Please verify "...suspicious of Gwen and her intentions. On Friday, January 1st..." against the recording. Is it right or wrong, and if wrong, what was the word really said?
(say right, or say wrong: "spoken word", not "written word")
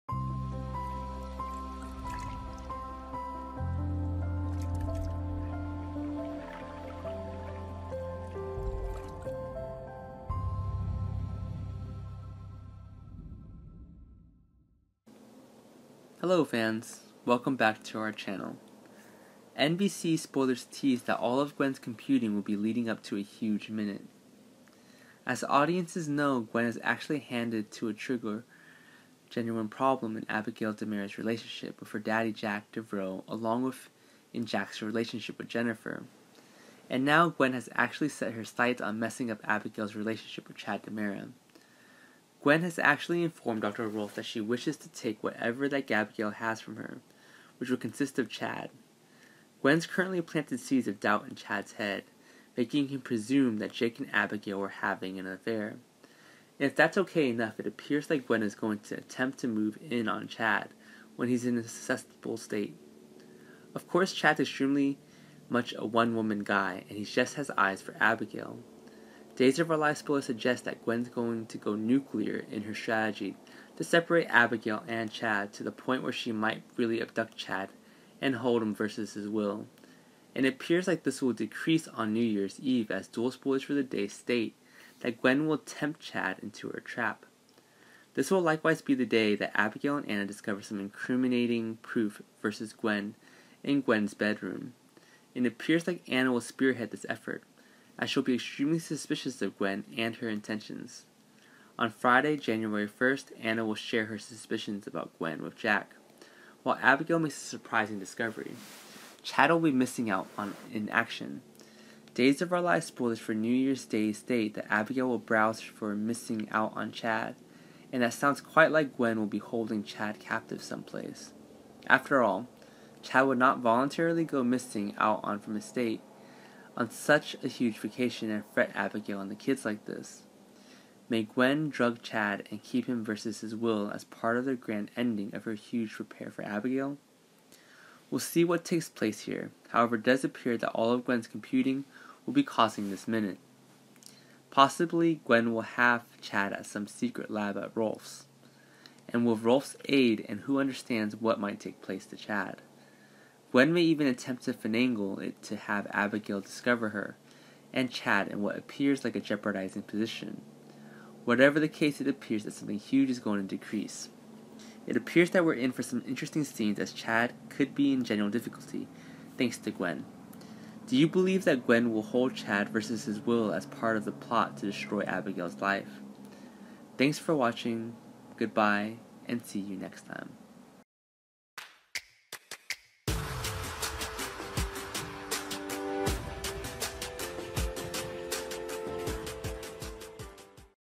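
right.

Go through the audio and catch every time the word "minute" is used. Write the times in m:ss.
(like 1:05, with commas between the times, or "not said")
0:23, 2:23.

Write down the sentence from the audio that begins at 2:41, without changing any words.
Whatever the case, it appears that something huge is going to decrease.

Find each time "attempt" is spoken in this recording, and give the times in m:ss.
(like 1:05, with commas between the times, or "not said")
0:58, 2:34.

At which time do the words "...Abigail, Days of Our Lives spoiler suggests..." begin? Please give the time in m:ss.
1:07.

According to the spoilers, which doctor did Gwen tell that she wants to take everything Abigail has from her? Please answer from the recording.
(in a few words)
Dr. Rolf.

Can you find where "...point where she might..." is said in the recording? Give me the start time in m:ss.
1:15.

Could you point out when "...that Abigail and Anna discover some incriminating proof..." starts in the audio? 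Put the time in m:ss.
1:29.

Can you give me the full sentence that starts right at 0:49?
Gwen's currently planted seeds of doubt in Chad's head, making him presume that Jake and Abigail were having an affair.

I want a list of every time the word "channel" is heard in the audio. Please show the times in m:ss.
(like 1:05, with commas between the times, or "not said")
0:18.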